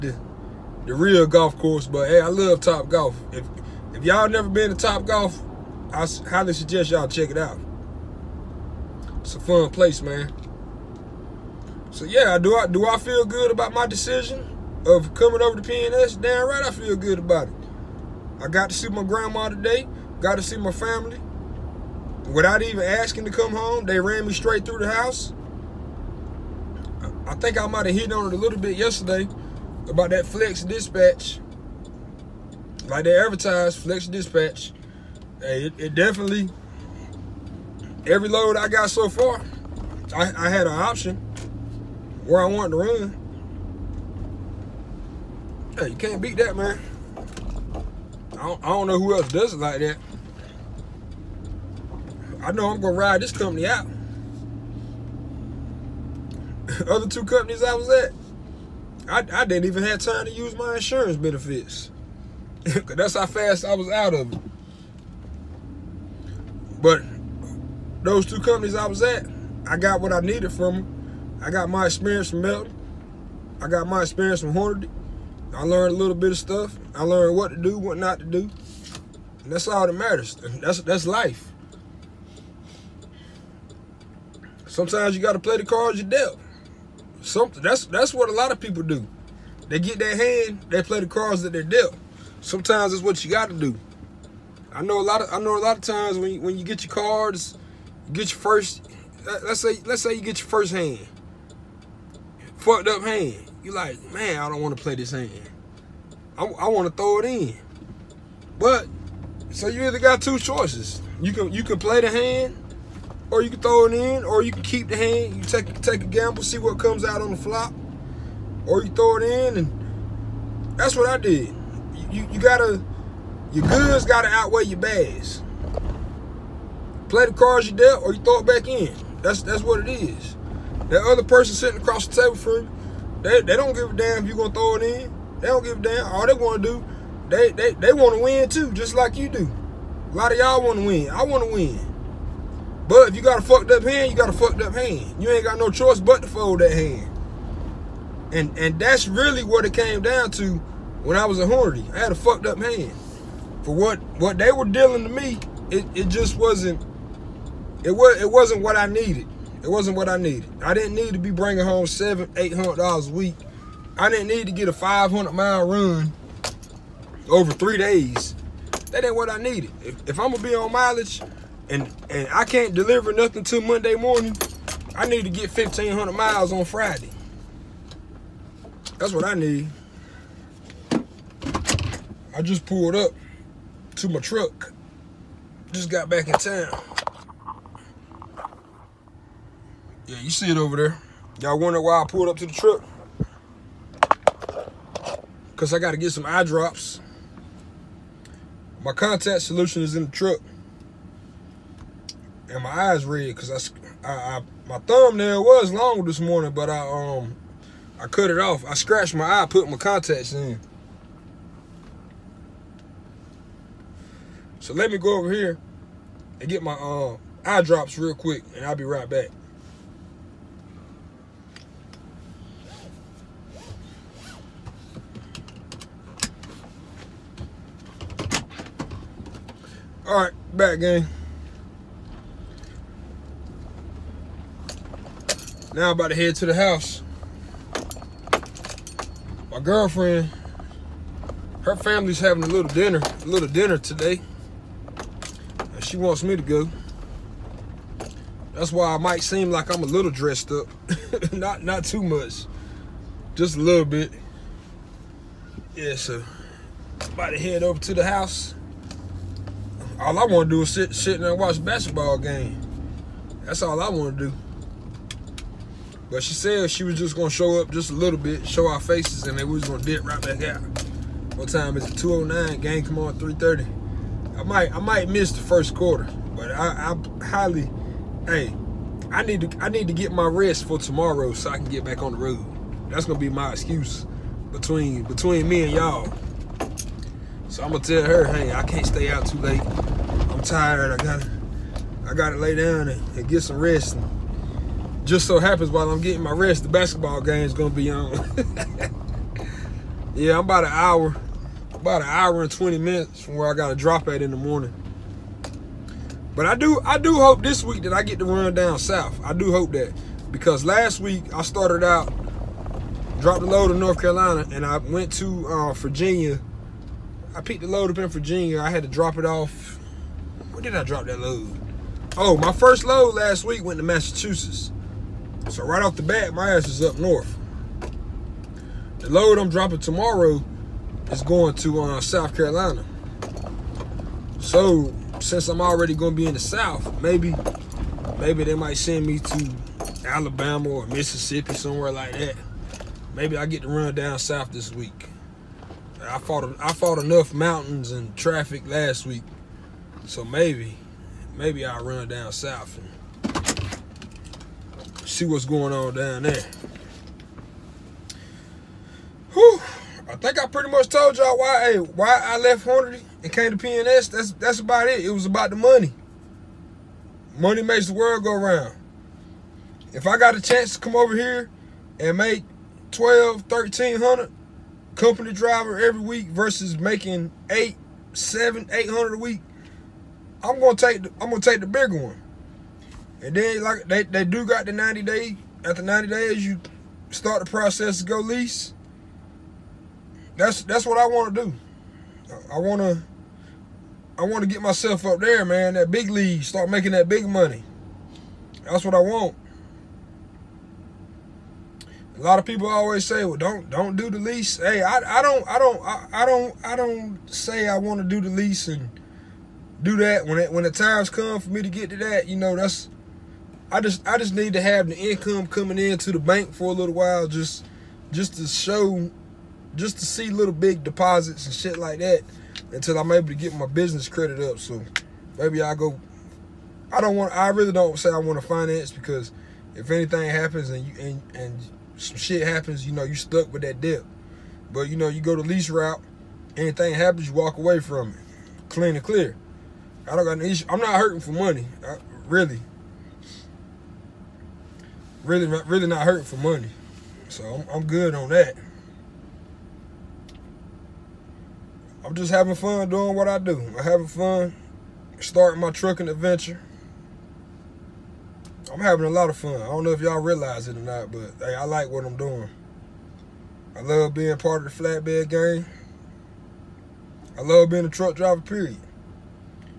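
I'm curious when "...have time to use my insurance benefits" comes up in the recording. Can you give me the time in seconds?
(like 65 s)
59 s.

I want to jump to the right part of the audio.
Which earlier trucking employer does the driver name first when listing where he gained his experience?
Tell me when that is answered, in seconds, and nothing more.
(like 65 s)
72 s.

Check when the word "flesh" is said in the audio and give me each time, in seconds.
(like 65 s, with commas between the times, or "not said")
not said.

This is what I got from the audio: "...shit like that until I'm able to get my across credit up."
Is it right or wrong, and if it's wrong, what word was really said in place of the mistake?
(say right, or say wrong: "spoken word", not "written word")
wrong: "business", not "across".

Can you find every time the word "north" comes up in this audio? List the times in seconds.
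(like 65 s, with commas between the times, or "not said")
313 s, 326 s.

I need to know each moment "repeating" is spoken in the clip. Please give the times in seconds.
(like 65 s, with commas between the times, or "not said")
not said.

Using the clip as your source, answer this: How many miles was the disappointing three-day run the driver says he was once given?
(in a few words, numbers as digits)
500.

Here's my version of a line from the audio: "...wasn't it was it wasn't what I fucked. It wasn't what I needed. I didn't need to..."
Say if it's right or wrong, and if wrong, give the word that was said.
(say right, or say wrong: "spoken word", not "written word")
wrong: "needed", not "fucked".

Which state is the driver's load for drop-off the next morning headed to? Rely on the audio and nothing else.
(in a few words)
South Carolina.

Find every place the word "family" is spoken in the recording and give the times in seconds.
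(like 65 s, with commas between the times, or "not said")
20 s, 241 s.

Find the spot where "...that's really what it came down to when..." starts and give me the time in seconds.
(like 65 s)
148 s.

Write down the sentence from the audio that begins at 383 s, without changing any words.
And then like they, they do got the 90 day after 90 days you start the process to go lease.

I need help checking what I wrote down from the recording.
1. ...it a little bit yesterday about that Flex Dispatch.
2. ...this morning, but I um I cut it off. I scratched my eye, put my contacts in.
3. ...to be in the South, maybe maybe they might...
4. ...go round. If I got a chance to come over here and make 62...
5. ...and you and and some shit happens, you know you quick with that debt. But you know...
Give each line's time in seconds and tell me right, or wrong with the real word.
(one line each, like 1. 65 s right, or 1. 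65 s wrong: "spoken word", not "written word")
1. 28 s right
2. 206 s right
3. 336 s right
4. 368 s wrong: "12", not "62"
5. 430 s wrong: "stuck", not "quick".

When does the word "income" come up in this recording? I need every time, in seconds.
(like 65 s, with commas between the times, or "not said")
414 s.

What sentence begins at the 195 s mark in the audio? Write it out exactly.
Because I got to get some eye drops.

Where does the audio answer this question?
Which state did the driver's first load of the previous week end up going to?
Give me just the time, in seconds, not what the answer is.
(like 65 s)
323 s.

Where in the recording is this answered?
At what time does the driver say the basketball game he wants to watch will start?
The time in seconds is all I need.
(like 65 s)
273 s.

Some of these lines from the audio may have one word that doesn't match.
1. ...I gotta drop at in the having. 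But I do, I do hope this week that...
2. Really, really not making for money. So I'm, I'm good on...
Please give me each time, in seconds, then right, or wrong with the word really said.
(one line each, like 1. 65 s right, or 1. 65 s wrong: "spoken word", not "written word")
1. 303 s wrong: "morning", not "having"
2. 445 s wrong: "hurting", not "making".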